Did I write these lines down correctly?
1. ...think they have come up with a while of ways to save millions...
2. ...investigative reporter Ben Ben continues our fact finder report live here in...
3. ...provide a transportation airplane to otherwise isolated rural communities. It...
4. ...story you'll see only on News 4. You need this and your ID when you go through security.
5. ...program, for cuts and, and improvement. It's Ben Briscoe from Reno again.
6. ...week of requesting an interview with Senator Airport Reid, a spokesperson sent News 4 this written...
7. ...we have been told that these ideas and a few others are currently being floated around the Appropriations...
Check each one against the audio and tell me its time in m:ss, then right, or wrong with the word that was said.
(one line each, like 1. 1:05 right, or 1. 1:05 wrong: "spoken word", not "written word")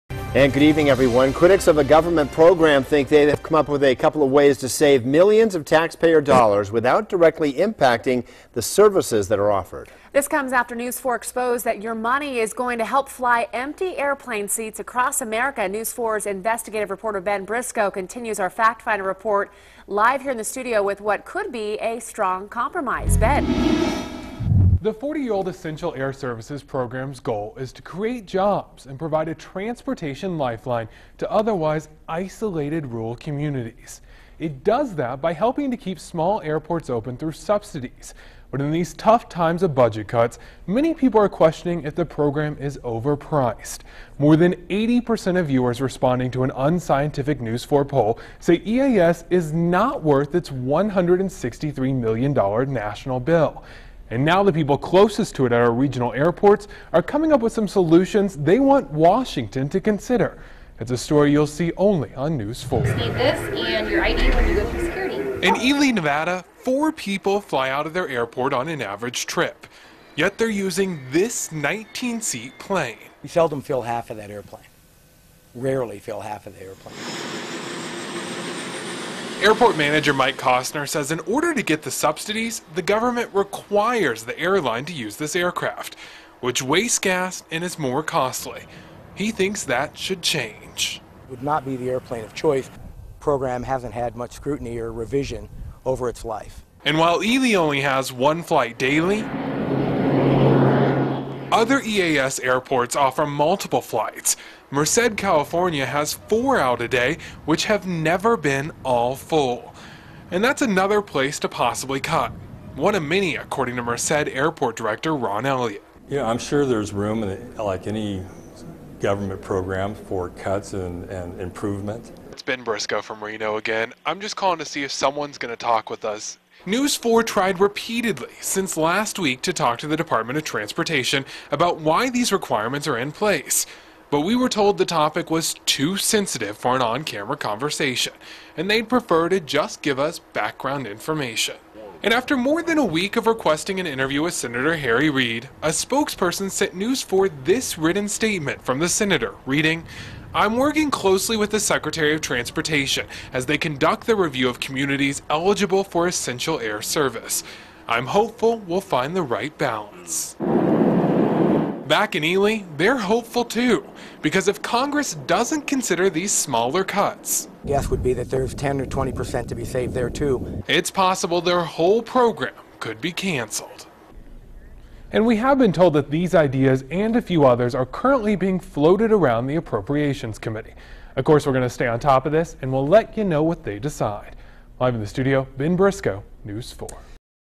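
1. 0:02 wrong: "couple", not "while"
2. 0:16 wrong: "Briscoe", not "Ben"
3. 0:28 wrong: "lifeline", not "airplane"
4. 1:00 right
5. 1:59 right
6. 2:22 wrong: "Harry", not "Airport"
7. 2:55 right.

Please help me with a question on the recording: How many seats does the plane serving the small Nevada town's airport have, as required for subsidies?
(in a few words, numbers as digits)
19.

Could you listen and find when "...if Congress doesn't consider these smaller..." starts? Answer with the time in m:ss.
2:44.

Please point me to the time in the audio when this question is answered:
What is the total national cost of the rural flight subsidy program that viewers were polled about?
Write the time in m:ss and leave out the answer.
0:50.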